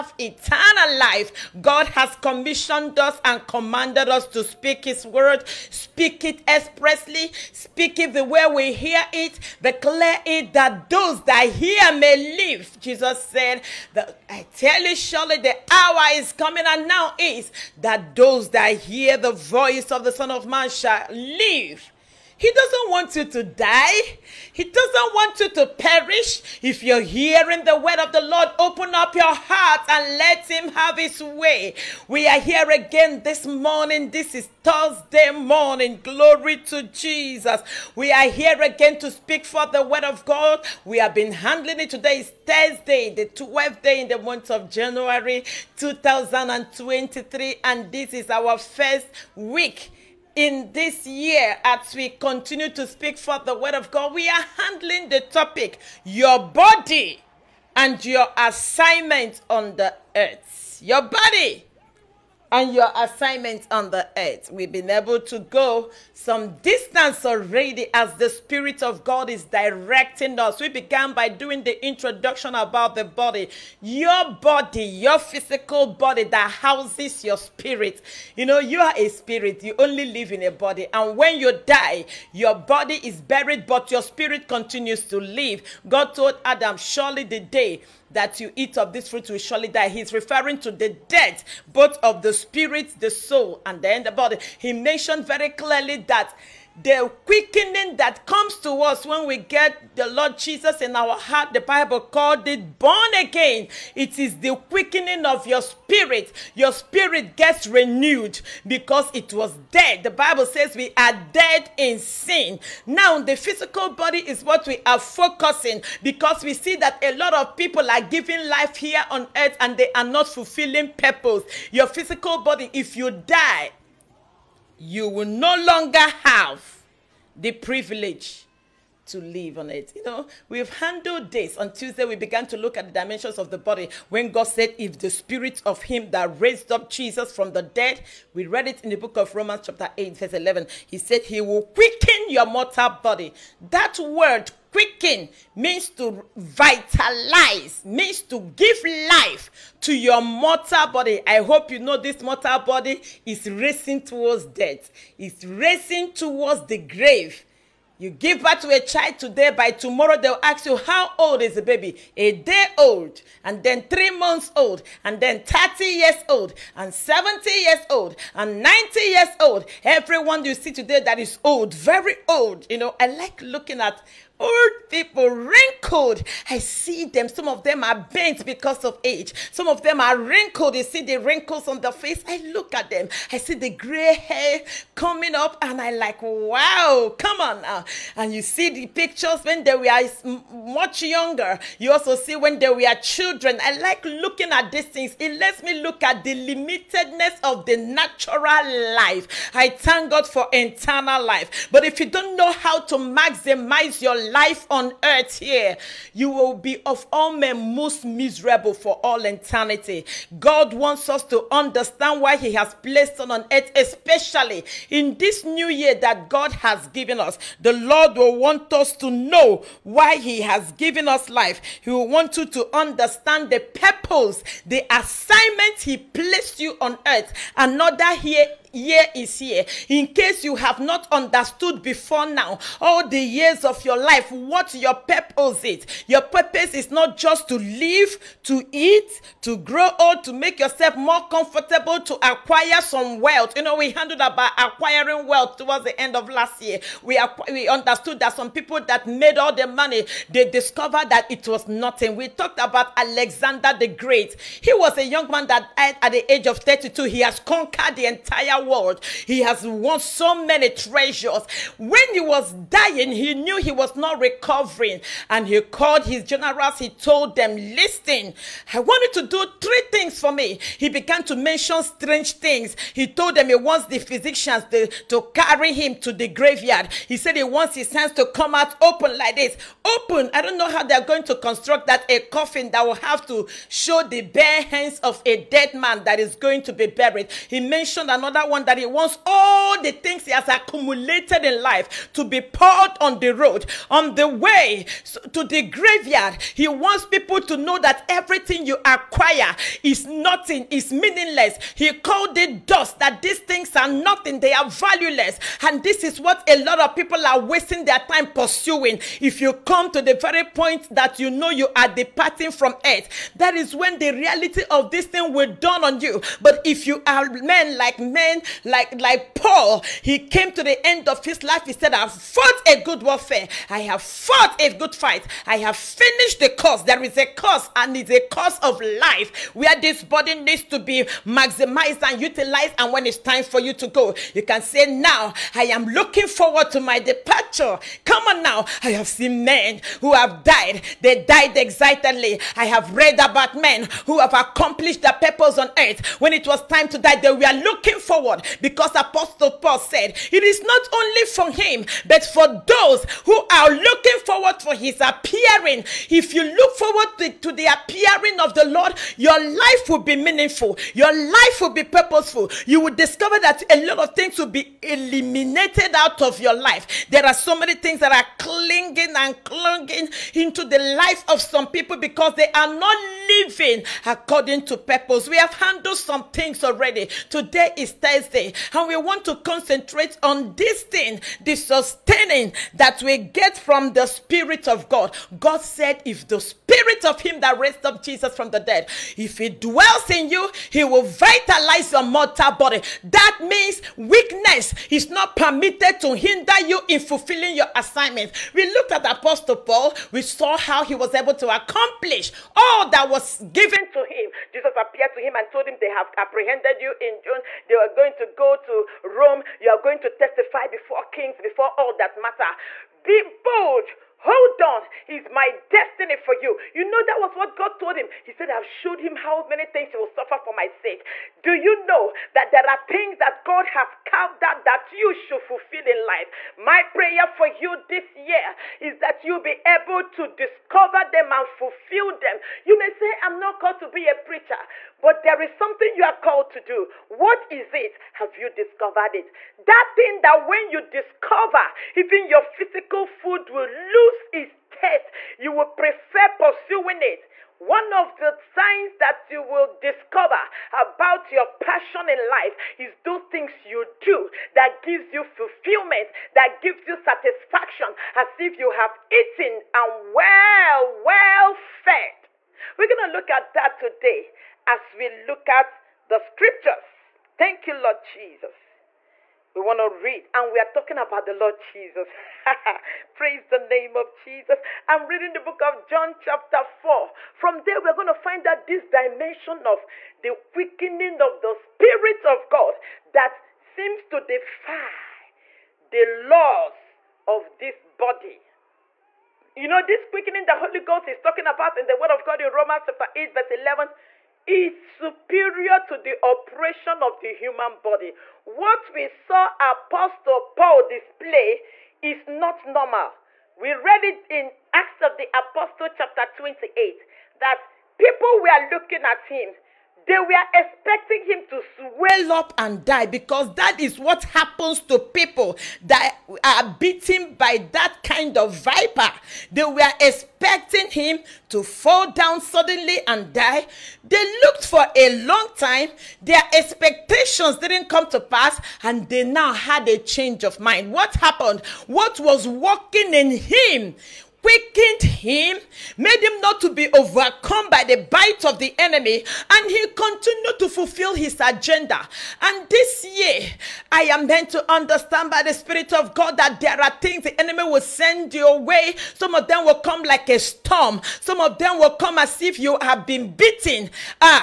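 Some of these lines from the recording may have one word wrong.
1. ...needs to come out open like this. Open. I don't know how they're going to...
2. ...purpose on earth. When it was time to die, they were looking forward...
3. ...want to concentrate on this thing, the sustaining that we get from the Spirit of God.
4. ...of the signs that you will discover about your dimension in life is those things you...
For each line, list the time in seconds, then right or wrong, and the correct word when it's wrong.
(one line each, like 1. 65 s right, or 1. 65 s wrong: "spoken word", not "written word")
1. 277 s wrong: "hands", not "needs"
2. 345 s right
3. 378 s right
4. 447 s wrong: "passion", not "dimension".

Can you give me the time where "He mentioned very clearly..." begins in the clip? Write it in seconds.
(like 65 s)
94 s.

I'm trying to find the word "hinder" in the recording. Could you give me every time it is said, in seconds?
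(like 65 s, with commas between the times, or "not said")
396 s.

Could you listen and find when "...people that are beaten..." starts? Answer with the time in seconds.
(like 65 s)
514 s.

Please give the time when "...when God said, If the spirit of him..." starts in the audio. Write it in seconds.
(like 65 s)
134 s.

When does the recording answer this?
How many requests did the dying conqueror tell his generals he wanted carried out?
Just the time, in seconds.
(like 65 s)
269 s.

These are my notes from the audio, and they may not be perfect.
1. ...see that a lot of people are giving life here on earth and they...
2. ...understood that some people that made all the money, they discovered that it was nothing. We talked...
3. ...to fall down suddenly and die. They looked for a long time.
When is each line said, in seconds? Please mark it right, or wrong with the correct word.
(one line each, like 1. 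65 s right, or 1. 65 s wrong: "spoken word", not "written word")
1. 116 s right
2. 247 s right
3. 521 s right.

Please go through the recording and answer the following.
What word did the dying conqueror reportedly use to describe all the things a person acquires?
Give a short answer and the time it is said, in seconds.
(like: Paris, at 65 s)
dust, at 302 s.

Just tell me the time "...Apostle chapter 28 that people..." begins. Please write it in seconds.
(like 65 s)
505 s.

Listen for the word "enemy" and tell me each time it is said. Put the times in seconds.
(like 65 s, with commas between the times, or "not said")
538 s, 547 s.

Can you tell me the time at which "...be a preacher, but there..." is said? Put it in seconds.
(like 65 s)
433 s.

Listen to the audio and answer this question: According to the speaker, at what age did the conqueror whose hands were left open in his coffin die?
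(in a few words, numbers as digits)
32.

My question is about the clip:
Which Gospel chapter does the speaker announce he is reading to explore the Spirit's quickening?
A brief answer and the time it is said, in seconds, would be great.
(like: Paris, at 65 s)
John 4, at 475 s.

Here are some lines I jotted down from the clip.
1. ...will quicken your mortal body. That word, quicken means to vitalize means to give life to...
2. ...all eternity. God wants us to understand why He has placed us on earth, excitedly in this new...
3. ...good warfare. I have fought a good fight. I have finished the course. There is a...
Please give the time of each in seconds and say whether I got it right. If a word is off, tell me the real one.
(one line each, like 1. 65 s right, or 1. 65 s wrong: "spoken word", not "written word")
1. 141 s right
2. 209 s wrong: "especially", not "excitedly"
3. 322 s right.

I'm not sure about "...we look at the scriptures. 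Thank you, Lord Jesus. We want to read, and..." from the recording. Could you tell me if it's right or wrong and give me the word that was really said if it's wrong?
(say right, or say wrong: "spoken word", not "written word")
right.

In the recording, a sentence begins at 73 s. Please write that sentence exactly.
Your body, your physical body that houses your spirit.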